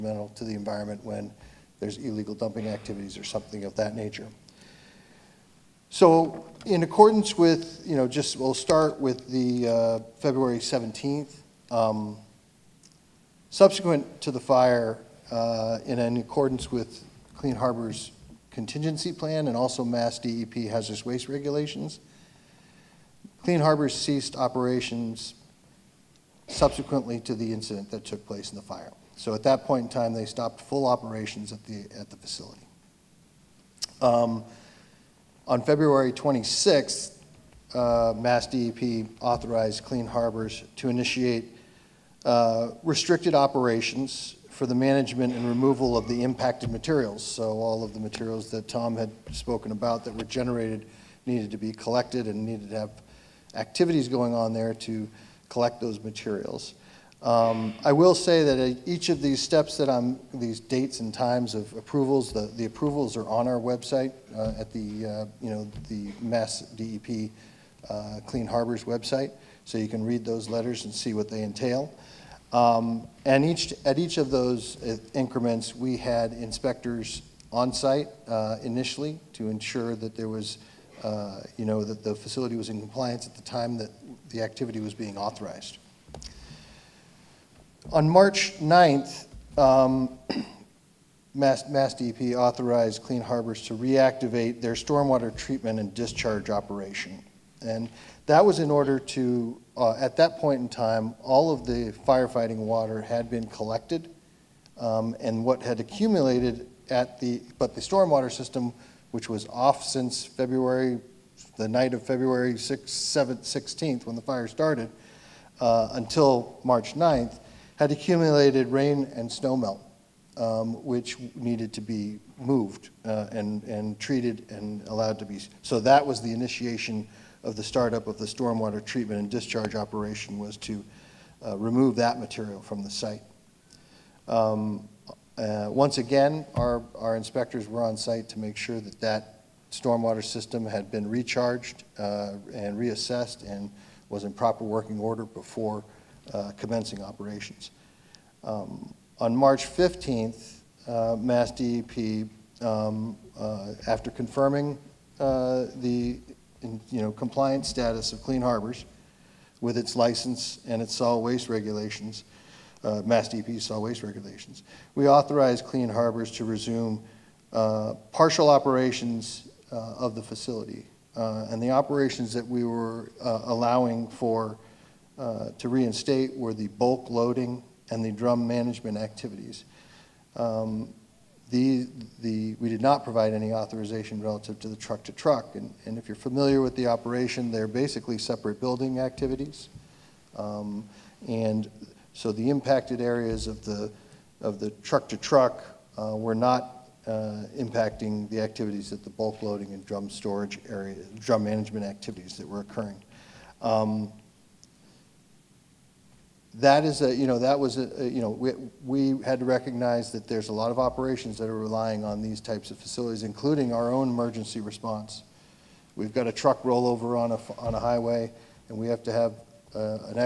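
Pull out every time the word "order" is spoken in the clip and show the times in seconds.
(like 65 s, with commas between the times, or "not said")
98 s, 144 s.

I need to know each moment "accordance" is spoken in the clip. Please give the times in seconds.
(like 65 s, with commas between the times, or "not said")
6 s, 16 s.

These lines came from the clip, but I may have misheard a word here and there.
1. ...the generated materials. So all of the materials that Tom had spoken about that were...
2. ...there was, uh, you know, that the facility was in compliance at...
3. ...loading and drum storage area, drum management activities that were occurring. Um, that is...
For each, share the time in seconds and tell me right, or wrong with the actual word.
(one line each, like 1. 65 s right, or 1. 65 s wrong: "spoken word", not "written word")
1. 46 s wrong: "impacted", not "generated"
2. 80 s right
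3. 199 s right.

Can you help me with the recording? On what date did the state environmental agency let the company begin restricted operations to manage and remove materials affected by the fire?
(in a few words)
February 26.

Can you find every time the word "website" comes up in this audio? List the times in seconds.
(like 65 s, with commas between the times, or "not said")
63 s, 68 s.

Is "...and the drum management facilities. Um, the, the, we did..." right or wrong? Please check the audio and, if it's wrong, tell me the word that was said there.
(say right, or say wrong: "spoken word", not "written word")
wrong: "activities", not "facilities".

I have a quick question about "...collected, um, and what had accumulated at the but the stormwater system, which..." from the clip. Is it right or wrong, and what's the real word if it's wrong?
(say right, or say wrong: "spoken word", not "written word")
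right.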